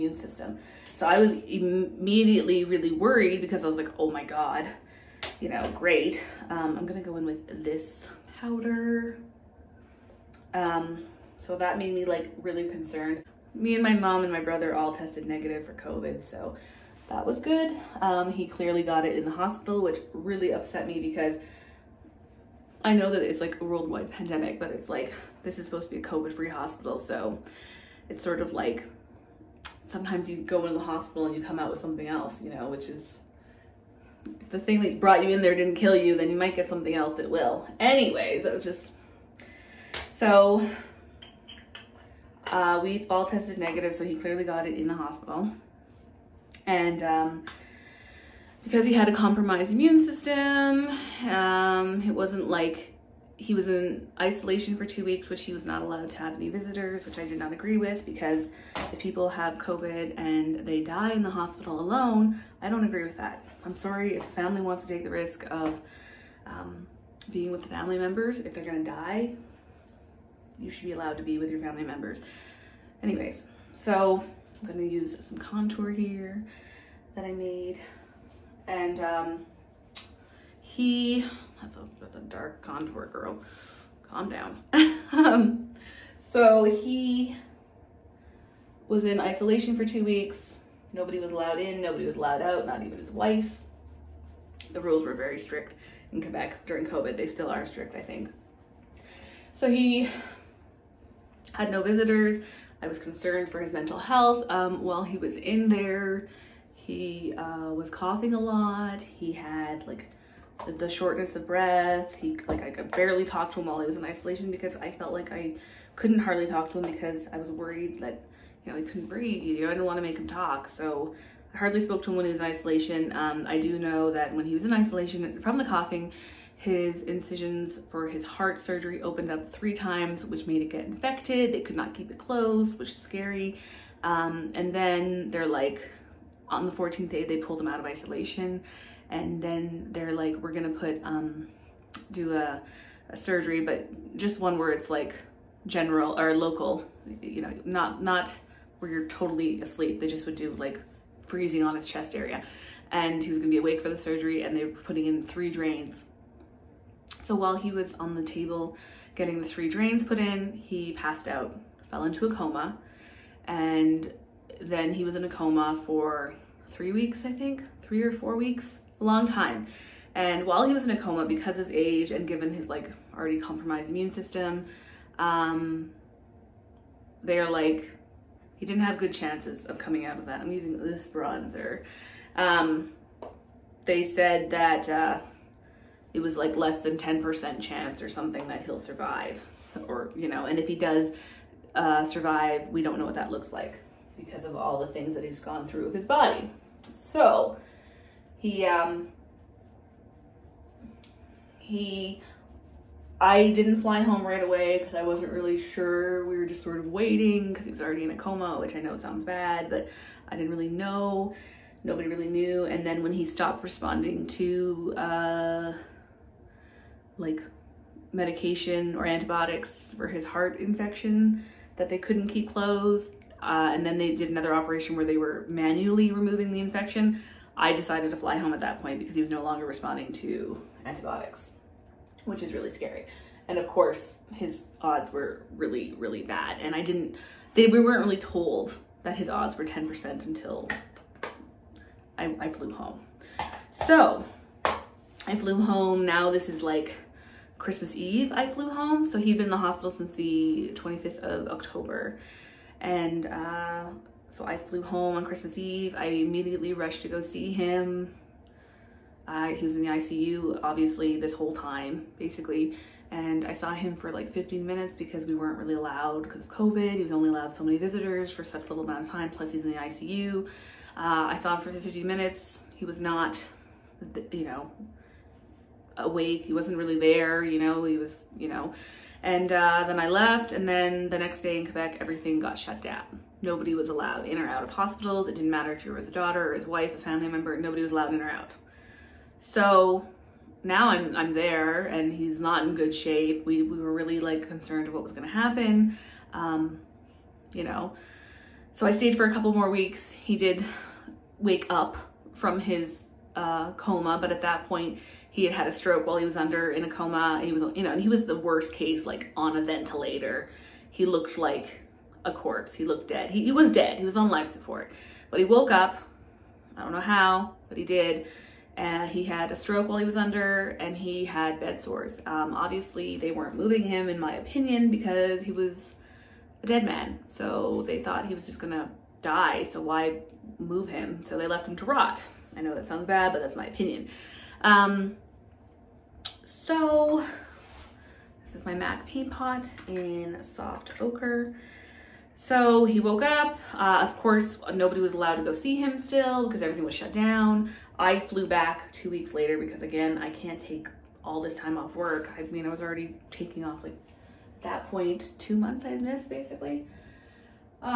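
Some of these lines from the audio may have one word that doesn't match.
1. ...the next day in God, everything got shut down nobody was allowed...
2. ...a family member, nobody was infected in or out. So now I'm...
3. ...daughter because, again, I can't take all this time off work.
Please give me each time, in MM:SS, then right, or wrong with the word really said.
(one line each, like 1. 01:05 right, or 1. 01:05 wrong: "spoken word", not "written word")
1. 04:41 wrong: "Quebec", not "God"
2. 04:46 wrong: "allowed", not "infected"
3. 05:49 wrong: "later", not "daughter".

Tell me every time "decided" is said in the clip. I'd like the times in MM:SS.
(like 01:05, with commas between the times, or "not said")
03:47.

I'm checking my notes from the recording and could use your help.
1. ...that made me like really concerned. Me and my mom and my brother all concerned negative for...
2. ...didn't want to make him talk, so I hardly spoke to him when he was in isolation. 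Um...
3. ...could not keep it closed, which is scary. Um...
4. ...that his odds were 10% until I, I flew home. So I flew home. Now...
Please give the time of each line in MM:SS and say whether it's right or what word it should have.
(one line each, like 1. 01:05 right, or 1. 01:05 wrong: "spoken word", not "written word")
1. 00:11 wrong: "tested", not "concerned"
2. 01:59 right
3. 02:11 right
4. 03:59 right.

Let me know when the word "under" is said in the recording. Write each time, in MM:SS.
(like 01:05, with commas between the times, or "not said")
05:06, 05:20.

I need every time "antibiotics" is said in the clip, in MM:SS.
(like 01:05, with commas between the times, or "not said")
03:39, 03:50.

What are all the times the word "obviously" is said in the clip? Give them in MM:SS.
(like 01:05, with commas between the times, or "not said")
04:20, 05:22.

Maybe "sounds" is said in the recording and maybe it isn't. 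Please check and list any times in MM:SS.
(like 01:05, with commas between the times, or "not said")
03:28, 05:32.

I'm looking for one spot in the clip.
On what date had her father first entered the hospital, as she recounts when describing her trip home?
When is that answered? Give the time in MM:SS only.
04:10.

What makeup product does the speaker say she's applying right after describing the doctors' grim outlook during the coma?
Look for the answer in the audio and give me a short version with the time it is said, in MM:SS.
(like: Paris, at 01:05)
bronzer, at 03:01.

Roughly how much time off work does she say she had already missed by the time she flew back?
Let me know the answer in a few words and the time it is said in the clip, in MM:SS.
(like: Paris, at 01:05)
2 months, at 05:55.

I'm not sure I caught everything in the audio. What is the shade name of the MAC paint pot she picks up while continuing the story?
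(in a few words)
Soft Ochre.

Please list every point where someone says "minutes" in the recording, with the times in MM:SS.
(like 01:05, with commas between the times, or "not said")
04:24, 04:32.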